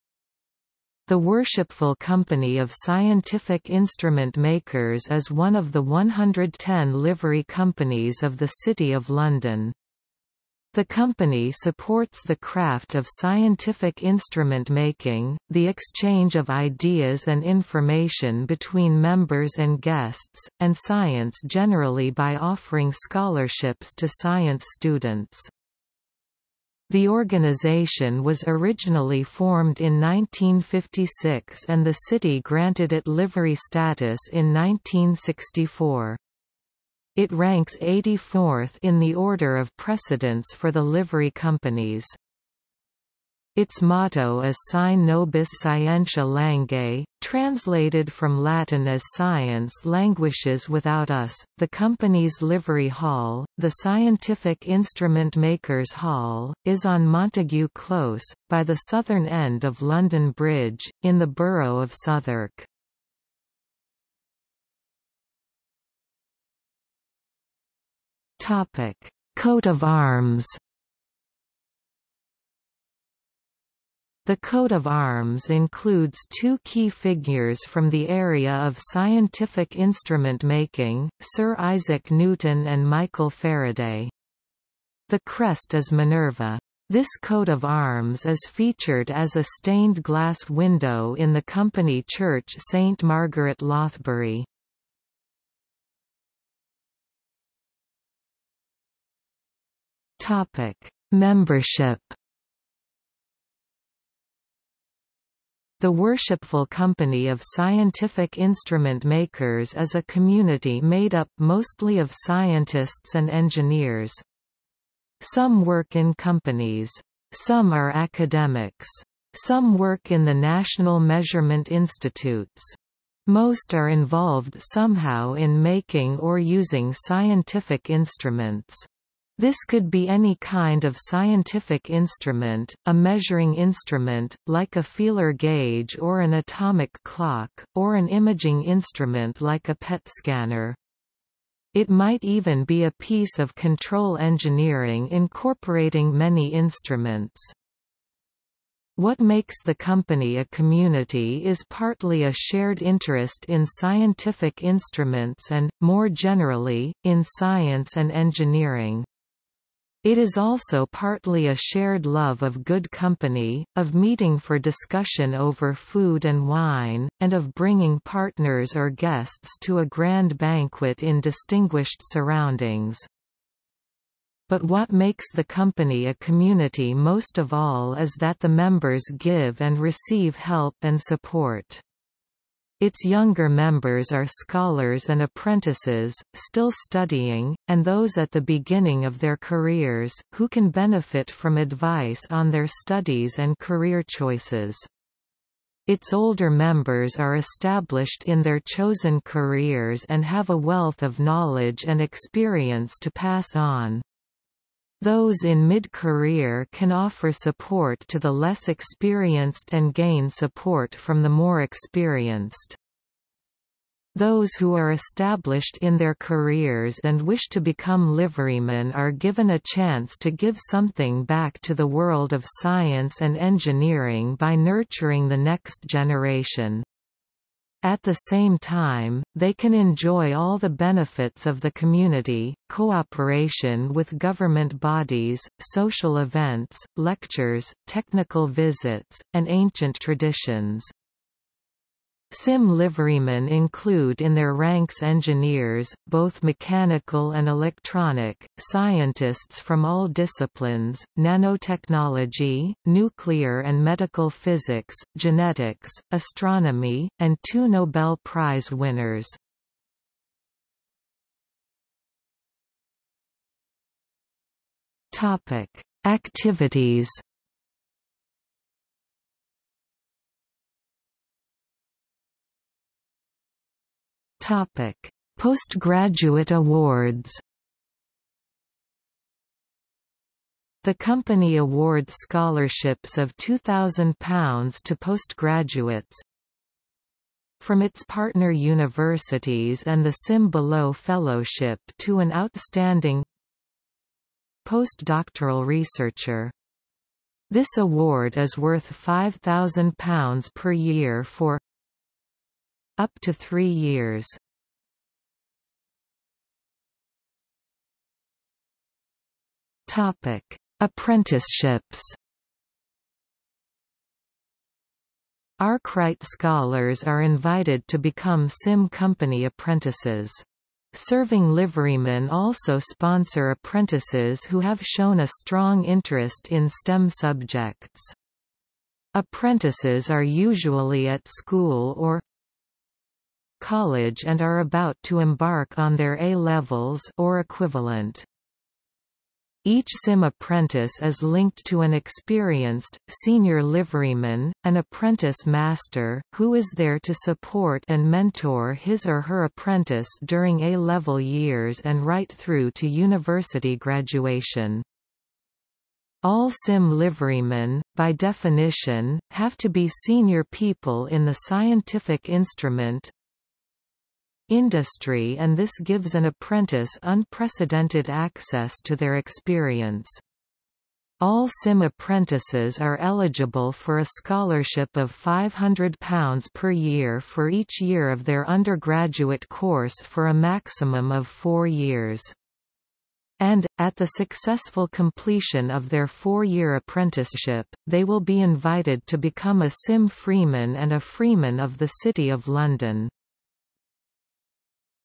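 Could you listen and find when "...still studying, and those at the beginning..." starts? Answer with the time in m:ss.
3:06.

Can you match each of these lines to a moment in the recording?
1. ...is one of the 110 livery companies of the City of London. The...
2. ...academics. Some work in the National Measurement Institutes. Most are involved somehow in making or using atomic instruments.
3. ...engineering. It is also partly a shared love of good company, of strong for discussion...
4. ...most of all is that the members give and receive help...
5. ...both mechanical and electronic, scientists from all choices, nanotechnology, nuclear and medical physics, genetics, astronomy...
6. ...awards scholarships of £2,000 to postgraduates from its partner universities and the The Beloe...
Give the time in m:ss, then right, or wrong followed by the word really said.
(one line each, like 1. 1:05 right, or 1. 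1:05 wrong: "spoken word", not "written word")
1. 0:05 right
2. 1:57 wrong: "scientific", not "atomic"
3. 2:38 wrong: "meeting", not "strong"
4. 2:56 right
5. 4:06 wrong: "disciplines", not "choices"
6. 4:41 wrong: "SIM", not "The".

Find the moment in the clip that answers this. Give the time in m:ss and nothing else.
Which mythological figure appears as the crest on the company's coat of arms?
1:25.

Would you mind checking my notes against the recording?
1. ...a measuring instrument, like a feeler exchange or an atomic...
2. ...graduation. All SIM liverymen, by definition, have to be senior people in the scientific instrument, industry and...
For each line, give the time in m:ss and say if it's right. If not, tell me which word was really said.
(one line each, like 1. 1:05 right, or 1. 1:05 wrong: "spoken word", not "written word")
1. 2:12 wrong: "gauge", not "exchange"
2. 5:53 right.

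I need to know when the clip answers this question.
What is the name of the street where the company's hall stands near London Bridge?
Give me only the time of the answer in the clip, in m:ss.
0:57.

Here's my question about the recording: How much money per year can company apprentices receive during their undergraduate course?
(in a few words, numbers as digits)
£500.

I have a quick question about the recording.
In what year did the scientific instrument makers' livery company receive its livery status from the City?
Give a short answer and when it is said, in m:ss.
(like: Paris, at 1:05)
1964, at 0:34.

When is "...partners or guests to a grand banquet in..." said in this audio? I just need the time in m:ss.
2:47.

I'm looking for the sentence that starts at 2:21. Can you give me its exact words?
It might even be a piece of control engineering incorporating many instruments.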